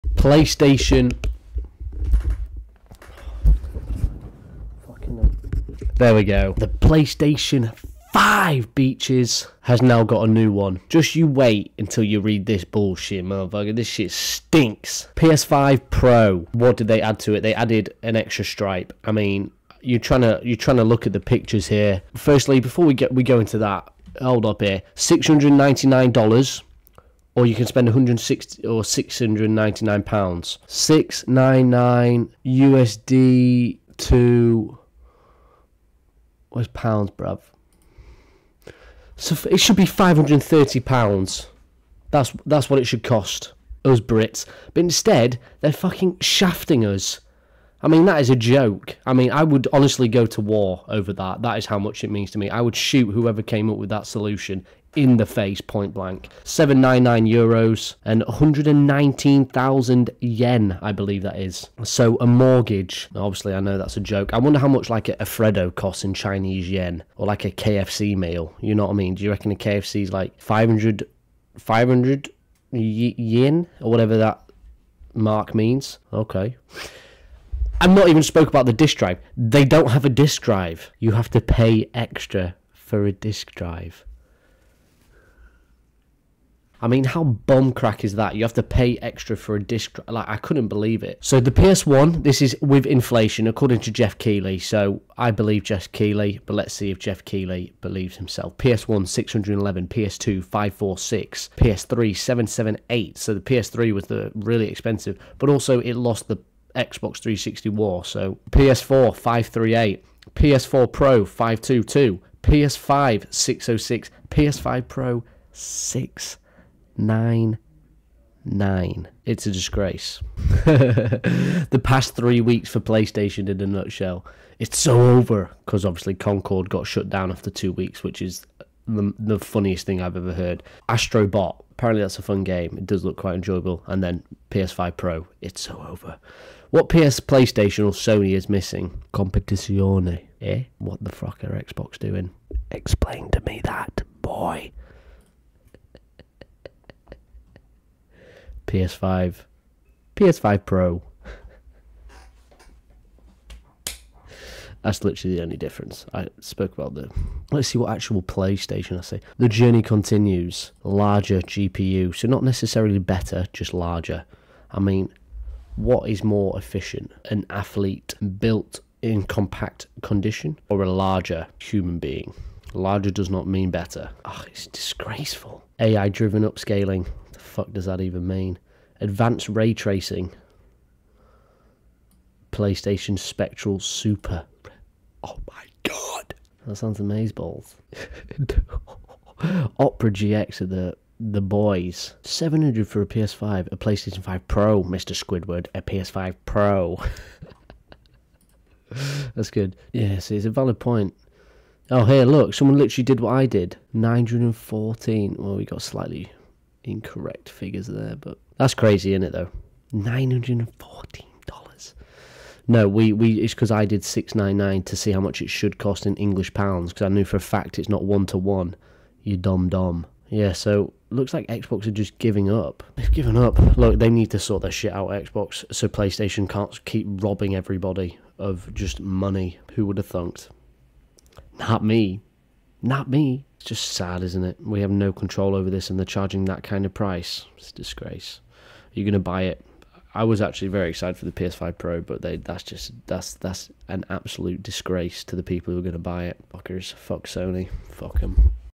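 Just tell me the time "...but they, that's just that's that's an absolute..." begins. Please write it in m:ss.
4:02.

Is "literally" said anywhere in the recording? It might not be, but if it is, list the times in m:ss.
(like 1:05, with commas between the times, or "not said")
2:35, 3:22.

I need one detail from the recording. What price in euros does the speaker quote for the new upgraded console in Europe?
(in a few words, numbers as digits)
799 euros.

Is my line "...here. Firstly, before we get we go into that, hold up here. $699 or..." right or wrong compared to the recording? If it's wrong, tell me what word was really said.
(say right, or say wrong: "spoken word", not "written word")
right.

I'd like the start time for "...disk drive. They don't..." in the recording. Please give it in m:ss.
1:18.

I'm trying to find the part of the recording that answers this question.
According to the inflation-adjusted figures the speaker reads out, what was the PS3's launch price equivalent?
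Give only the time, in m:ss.
1:41.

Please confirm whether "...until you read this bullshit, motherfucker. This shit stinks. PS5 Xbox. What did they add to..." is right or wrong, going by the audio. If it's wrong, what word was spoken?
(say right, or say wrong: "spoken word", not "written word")
wrong: "Pro", not "Xbox".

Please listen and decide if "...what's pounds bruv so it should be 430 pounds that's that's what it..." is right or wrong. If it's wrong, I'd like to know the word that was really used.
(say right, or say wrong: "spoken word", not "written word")
wrong: "530", not "430".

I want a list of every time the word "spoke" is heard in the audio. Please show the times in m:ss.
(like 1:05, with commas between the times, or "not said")
1:18, 2:36.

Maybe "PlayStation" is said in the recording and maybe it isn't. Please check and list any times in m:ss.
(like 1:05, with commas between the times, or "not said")
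0:00, 0:06, 2:02, 2:17, 2:38, 3:02, 3:13, 3:45.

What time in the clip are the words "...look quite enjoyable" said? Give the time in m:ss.
2:13.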